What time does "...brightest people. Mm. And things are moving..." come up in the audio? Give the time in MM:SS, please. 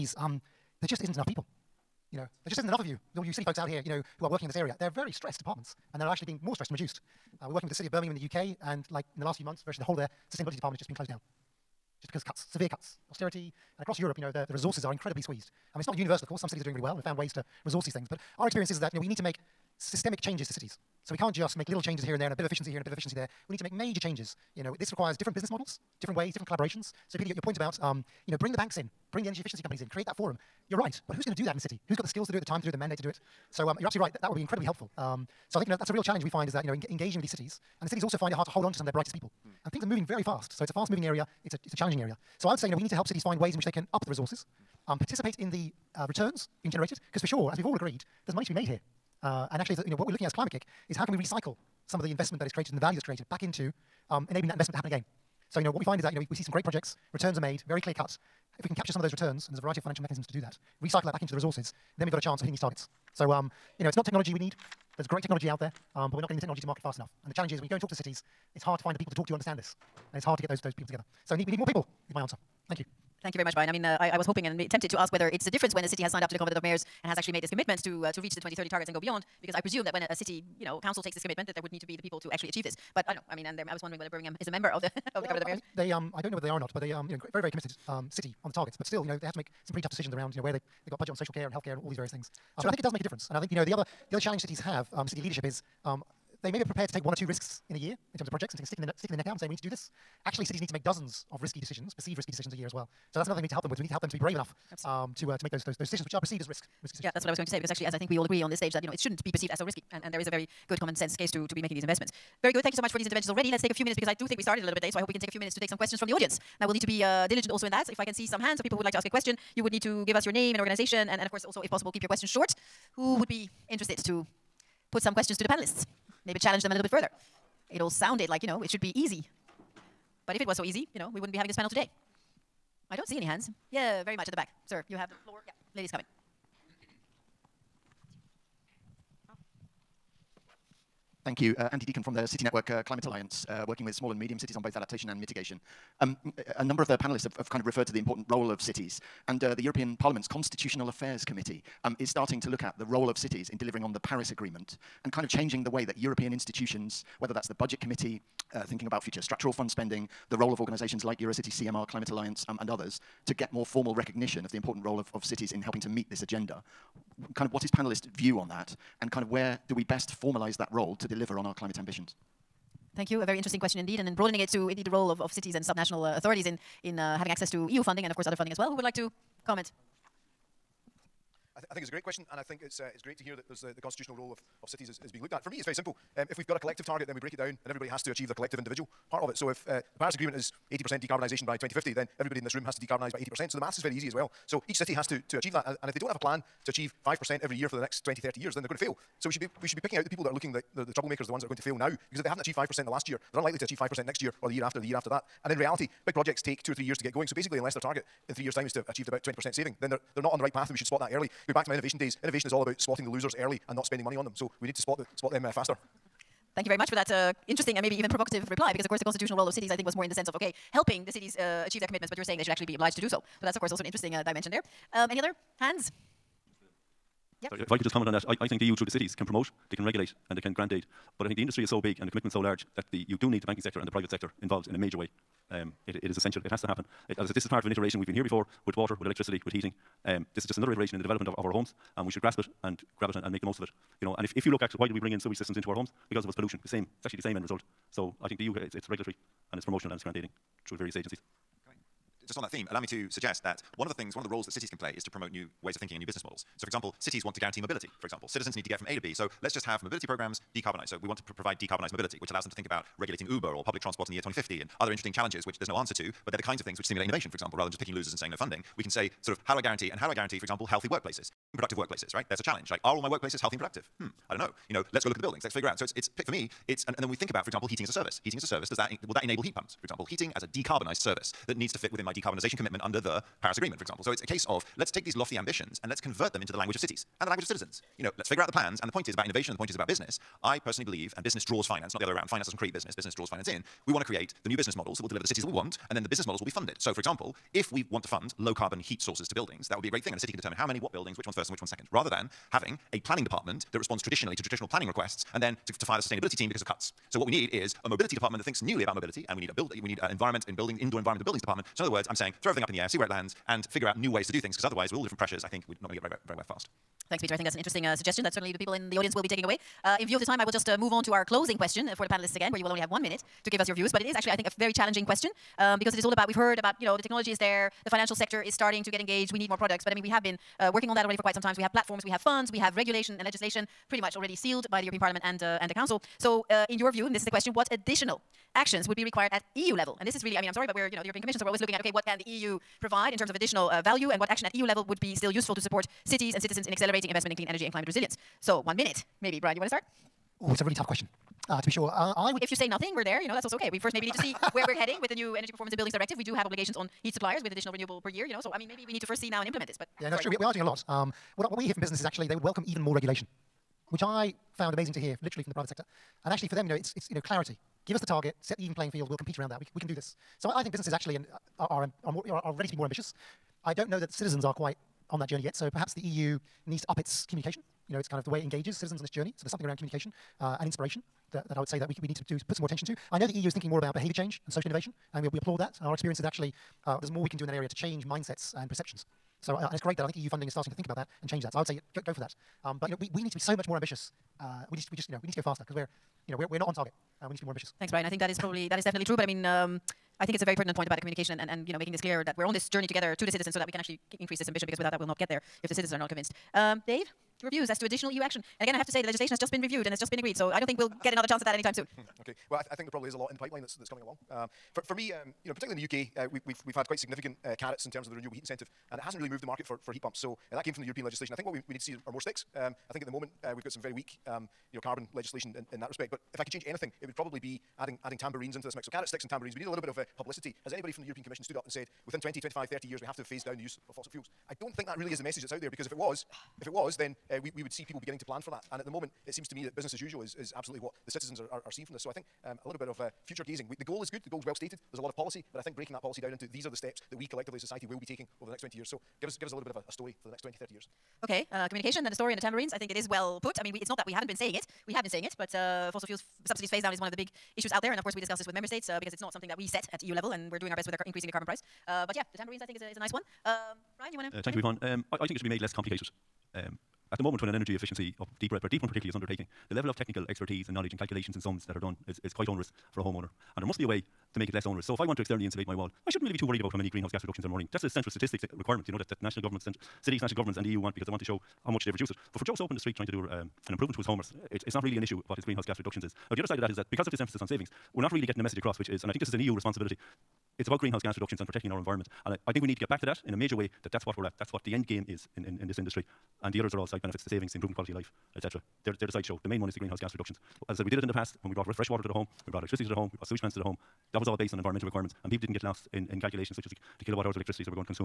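00:38.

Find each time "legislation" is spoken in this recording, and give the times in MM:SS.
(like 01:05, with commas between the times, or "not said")
05:33, 06:49, 07:01, 07:05.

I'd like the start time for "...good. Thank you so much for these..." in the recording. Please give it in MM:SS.
01:52.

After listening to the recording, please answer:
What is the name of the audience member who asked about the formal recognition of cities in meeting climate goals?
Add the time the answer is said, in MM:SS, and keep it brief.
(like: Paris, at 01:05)
Andy Deacon, at 02:21.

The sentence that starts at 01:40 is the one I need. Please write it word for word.
Actually, cities need to make dozens of risky decisions, perceived risky decisions a year as well.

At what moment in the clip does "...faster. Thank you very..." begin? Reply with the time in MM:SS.
03:35.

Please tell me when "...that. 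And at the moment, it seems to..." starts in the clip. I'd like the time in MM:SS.
07:18.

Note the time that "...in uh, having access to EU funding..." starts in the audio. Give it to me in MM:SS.
02:56.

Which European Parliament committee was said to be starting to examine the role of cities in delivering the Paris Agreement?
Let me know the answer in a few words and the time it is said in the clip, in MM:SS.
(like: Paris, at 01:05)
Constitutional Affairs Committee, at 02:30.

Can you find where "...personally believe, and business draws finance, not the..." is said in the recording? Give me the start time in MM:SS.
04:50.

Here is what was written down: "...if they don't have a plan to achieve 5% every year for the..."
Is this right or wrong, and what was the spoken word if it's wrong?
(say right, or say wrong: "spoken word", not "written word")
right.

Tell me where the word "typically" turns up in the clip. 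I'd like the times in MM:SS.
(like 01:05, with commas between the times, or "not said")
not said.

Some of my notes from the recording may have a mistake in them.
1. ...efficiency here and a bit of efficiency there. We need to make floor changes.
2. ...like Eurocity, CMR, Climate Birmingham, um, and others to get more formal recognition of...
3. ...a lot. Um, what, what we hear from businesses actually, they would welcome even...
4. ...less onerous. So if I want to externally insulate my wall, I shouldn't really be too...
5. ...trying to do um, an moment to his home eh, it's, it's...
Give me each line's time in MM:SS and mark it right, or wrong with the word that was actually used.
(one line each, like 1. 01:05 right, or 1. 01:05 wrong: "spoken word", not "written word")
1. 00:22 wrong: "major", not "floor"
2. 02:41 wrong: "Alliance", not "Birmingham"
3. 06:00 right
4. 07:54 right
5. 08:02 wrong: "improvement", not "moment".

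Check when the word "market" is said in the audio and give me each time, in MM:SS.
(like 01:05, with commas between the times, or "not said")
01:06, 06:59.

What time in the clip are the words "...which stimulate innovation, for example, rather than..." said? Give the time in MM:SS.
04:26.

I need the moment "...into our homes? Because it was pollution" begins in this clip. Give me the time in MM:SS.
04:05.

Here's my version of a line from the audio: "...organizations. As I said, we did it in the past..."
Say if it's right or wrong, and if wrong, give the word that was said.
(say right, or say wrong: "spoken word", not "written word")
wrong: "reductions", not "organizations".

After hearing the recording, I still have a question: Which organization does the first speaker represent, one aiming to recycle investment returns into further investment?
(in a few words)
Climate-KIC.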